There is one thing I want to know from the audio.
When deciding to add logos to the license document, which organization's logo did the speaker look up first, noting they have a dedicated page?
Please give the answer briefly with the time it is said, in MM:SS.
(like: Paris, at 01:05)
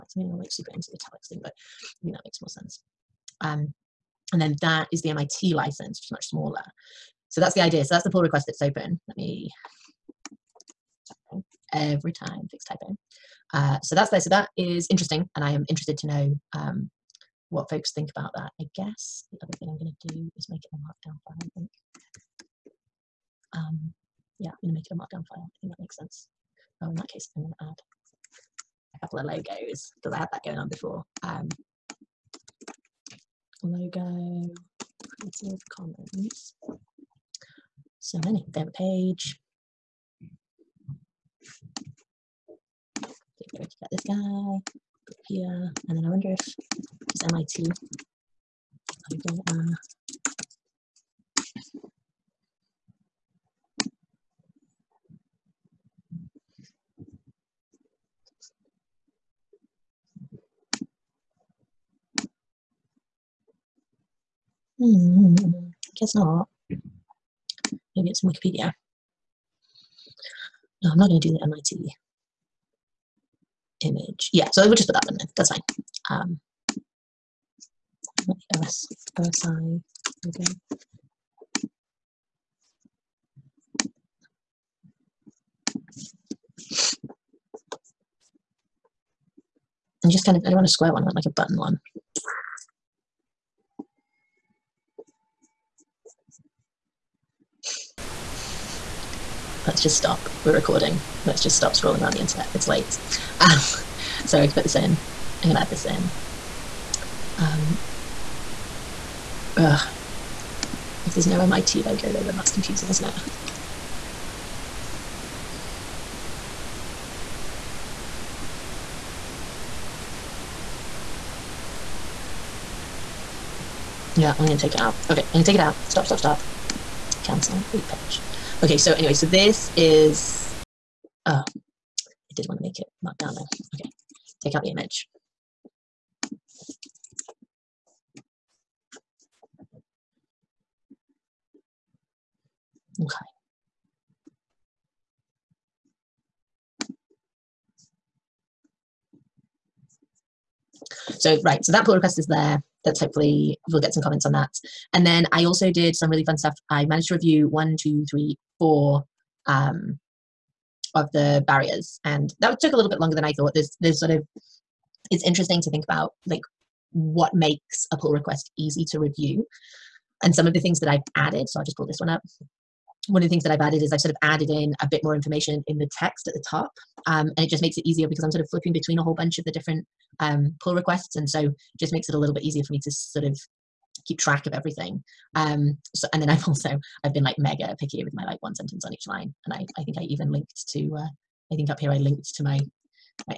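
Creative Commons, at 00:35.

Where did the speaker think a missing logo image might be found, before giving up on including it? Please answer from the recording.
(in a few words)
Wikipedia.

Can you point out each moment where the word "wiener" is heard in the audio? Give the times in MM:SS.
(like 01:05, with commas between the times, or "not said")
not said.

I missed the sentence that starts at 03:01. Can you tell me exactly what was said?
And so just makes it a little bit easier for me to sort of keep track of everything.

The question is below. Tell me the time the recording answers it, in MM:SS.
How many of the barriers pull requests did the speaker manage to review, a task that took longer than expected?
02:38.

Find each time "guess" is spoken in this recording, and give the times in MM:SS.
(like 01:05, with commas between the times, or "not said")
00:18, 01:05.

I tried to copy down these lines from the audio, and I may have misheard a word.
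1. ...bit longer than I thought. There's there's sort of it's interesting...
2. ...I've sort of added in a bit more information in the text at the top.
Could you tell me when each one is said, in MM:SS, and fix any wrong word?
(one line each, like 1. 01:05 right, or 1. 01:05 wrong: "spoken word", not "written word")
1. 02:42 right
2. 02:53 right.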